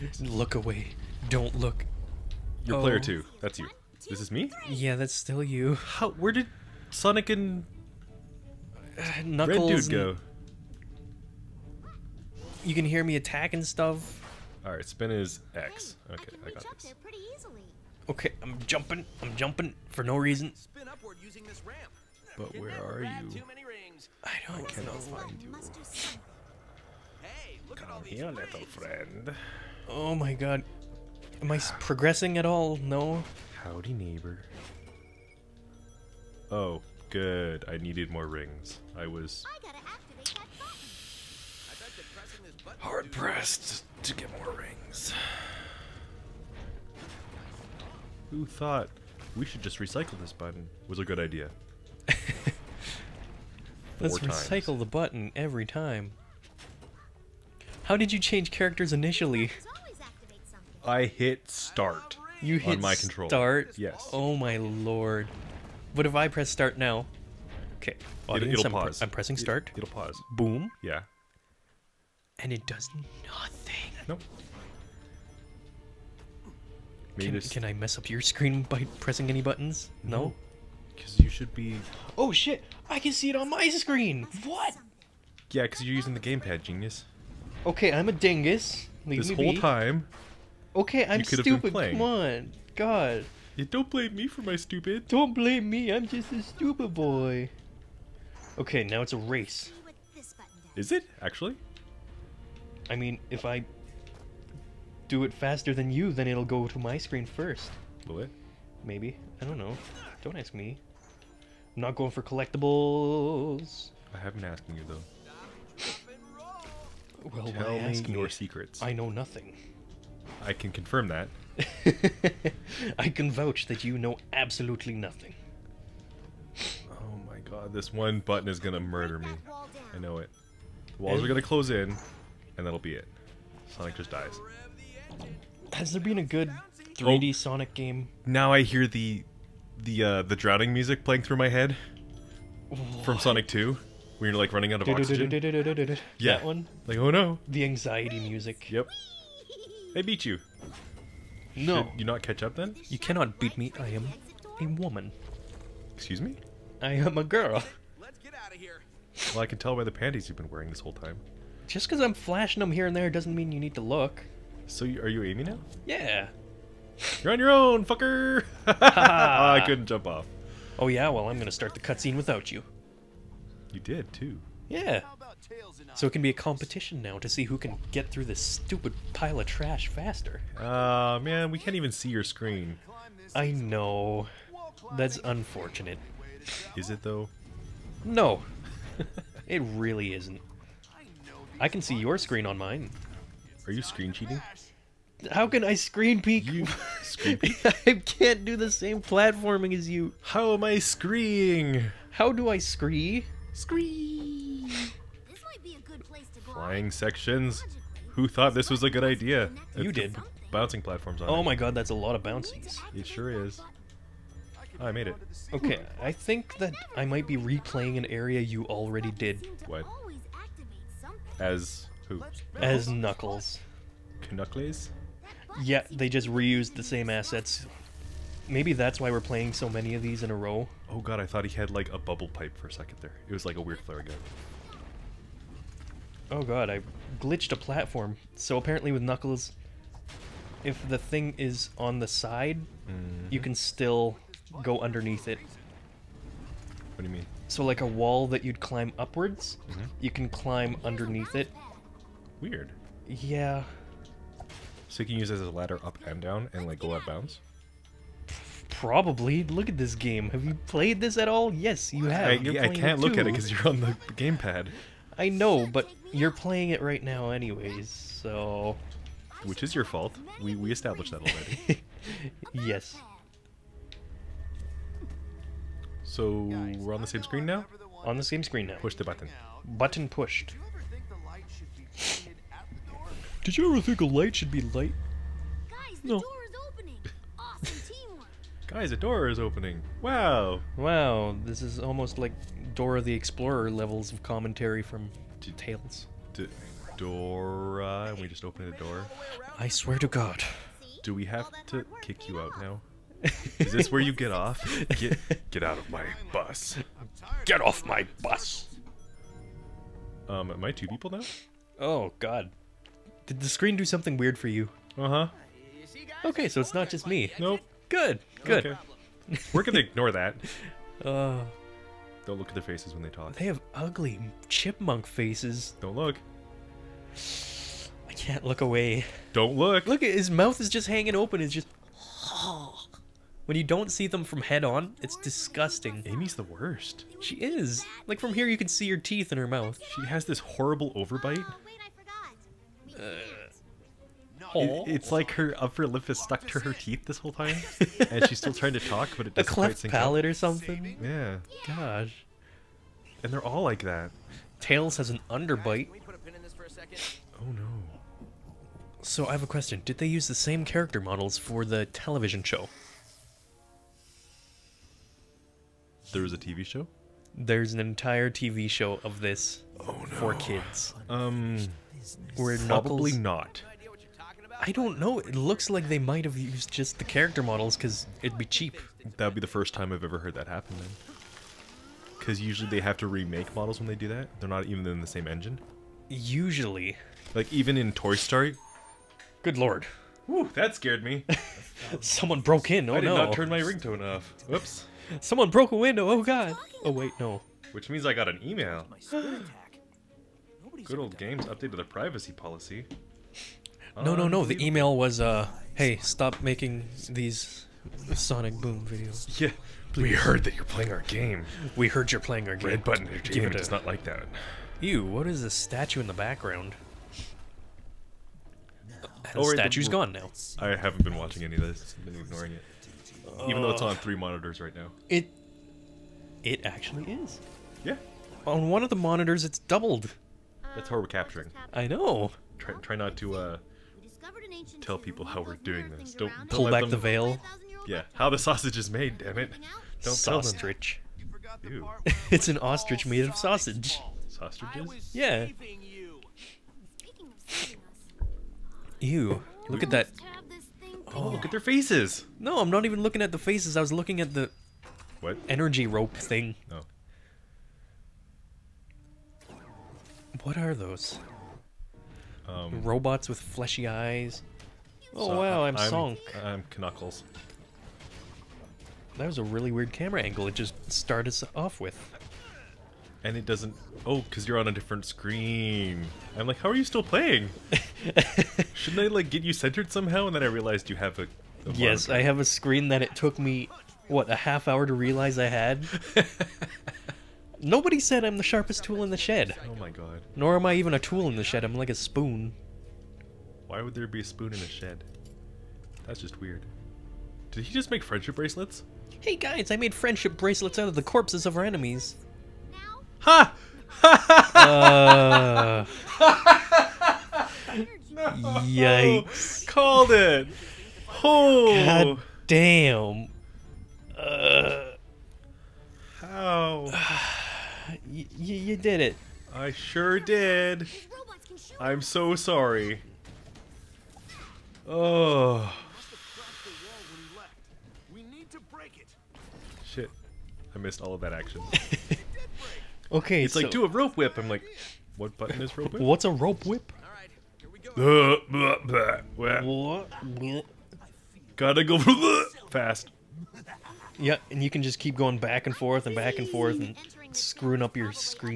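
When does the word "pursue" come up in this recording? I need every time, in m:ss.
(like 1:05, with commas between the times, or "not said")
not said.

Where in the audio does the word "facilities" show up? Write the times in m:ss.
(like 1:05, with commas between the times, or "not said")
not said.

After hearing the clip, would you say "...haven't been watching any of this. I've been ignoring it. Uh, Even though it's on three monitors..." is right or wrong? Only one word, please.
right.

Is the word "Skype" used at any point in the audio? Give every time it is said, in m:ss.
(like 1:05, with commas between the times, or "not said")
not said.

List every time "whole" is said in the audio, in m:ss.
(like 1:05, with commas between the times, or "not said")
1:29, 2:40, 5:47.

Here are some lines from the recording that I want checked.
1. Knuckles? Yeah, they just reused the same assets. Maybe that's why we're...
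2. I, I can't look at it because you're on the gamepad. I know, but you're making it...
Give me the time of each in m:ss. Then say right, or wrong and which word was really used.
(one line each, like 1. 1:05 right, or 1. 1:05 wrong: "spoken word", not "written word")
1. 3:44 right
2. 4:22 wrong: "playing", not "making".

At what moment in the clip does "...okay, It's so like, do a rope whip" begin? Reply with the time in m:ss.
8:53.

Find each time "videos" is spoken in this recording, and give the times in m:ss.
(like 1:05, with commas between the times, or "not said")
6:48.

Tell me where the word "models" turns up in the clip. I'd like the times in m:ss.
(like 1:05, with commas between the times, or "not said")
6:00, 6:17, 6:23.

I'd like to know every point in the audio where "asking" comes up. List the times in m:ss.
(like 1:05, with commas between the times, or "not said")
1:54.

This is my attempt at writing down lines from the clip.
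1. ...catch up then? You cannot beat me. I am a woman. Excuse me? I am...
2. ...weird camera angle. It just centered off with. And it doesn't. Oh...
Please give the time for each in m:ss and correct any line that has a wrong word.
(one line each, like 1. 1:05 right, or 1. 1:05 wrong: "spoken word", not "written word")
1. 2:32 right
2. 7:49 wrong: "started", not "centered".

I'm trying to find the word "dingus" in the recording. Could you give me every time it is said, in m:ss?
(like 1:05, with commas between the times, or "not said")
1:28.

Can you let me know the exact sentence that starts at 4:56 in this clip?
D Dora, and we just opened the door.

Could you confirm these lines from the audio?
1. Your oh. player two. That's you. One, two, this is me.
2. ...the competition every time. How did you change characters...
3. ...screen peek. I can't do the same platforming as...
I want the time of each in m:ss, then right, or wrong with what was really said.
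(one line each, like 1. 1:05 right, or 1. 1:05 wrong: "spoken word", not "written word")
1. 0:02 right
2. 0:54 wrong: "button", not "competition"
3. 3:17 right.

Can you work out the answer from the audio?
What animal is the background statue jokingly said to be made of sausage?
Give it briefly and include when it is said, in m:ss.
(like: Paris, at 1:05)
Ostrich, at 7:22.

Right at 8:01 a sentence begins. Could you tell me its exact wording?
a yes, I have a screen that it took me what a half hour to realize I had.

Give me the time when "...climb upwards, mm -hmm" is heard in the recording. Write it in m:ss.
4:08.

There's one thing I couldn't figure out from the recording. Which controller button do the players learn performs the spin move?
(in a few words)
X.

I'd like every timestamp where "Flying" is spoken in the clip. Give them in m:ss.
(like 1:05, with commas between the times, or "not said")
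3:26.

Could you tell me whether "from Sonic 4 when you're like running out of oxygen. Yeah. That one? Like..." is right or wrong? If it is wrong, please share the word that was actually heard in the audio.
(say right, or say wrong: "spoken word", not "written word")
wrong: "2", not "4".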